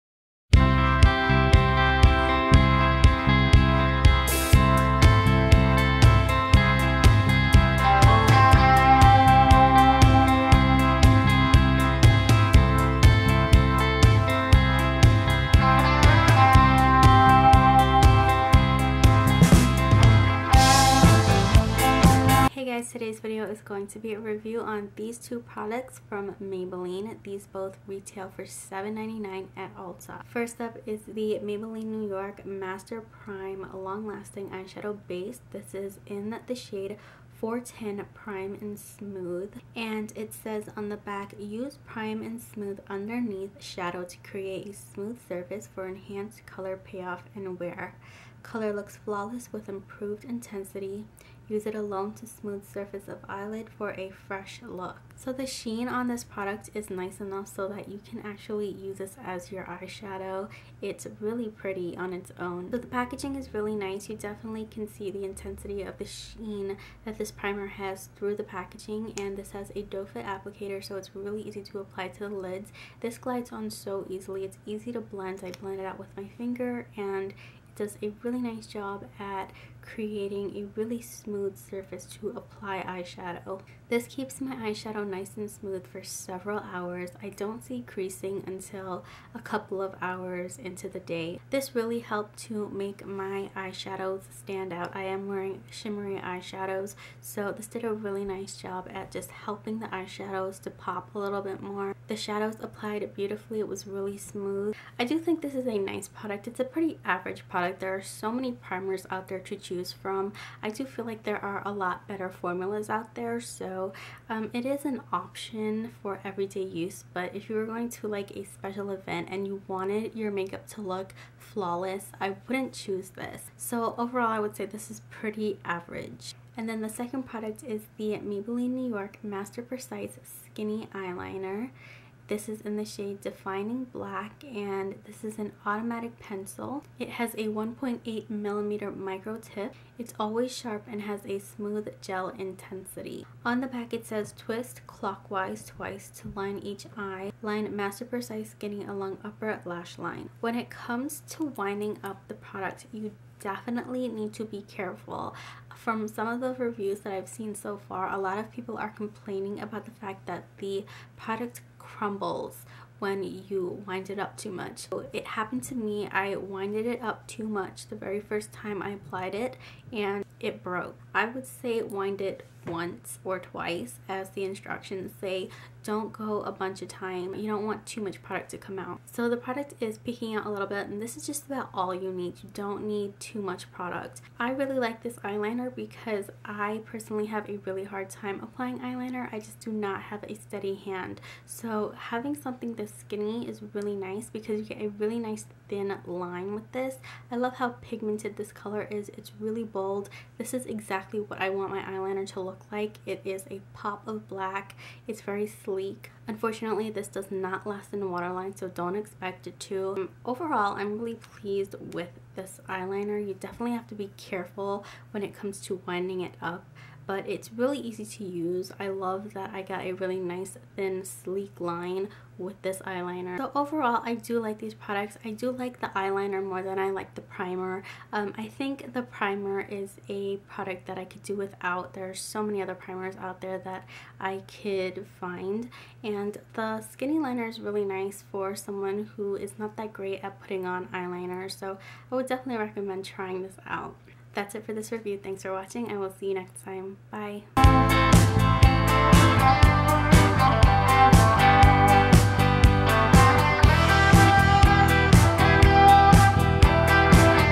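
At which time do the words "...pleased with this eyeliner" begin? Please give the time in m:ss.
3:31.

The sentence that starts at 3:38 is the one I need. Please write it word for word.
I love that I got a really nice thin sleek line with this eyeliner.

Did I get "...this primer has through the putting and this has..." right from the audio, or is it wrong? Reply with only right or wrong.
wrong.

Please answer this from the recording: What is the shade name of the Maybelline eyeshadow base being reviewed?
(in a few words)
410 Prime and Smooth.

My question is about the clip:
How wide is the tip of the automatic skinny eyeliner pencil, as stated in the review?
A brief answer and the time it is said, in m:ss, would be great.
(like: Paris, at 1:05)
1.8 millimeter, at 2:17.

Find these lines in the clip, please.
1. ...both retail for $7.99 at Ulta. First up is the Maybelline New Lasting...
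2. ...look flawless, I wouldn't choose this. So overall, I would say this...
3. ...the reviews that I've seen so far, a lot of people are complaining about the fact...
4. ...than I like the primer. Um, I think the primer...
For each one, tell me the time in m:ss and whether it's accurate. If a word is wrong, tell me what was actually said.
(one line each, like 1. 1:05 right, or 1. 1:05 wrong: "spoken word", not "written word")
1. 0:27 wrong: "York", not "Lasting"
2. 2:00 right
3. 2:36 right
4. 3:46 right.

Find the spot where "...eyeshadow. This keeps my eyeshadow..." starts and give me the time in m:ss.
1:22.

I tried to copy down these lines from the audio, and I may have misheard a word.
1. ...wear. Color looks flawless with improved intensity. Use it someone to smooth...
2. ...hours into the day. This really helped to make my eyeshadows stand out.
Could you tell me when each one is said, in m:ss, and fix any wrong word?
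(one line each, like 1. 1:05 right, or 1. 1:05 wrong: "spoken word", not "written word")
1. 0:47 wrong: "alone", not "someone"
2. 1:29 right.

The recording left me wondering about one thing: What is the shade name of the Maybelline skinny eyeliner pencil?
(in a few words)
Defining Black.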